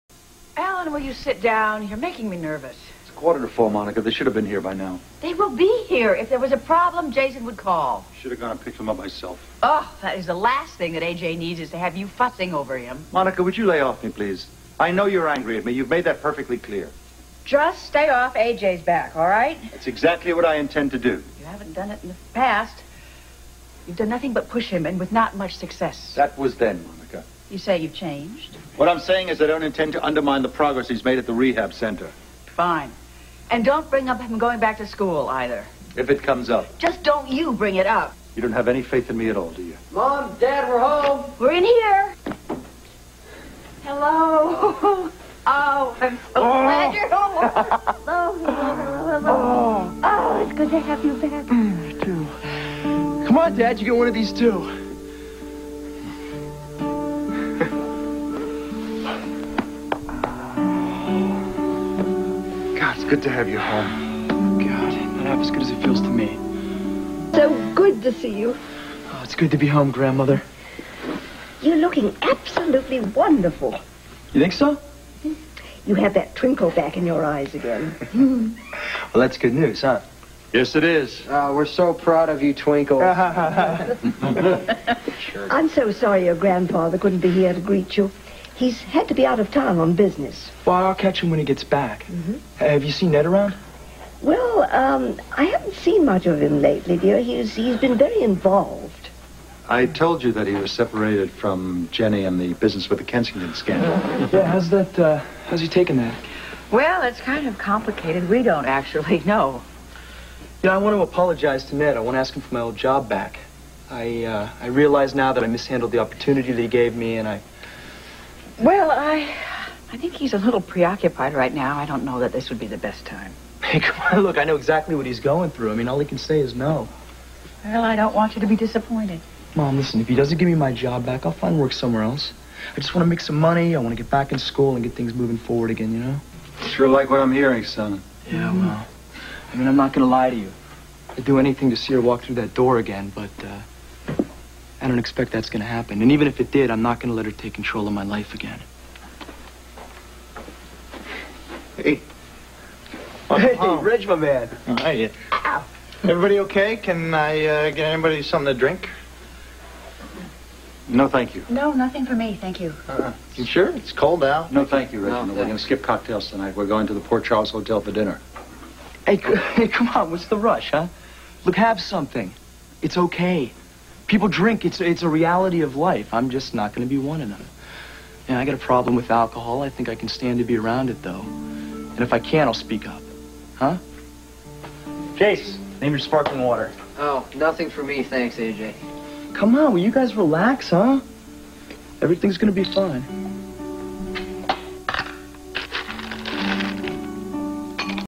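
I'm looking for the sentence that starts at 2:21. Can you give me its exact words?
I'd do anything to see her walk through that door again, but, uh, I don't expect that's going to happen.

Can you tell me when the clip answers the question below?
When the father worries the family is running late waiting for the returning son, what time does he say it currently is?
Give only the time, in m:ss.
0:03.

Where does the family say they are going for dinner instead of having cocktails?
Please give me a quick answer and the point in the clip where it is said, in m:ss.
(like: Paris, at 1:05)
Port Charles Hotel, at 2:47.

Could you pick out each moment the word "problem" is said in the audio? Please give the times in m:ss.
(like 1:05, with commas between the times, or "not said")
0:06, 2:58.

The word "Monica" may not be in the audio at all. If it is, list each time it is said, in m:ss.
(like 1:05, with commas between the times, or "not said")
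0:03, 0:13, 0:26.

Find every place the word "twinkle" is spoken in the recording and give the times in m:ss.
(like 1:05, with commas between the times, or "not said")
1:16, 1:22.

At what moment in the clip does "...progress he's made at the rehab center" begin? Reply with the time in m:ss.
0:30.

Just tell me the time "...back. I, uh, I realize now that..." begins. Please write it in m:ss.
1:53.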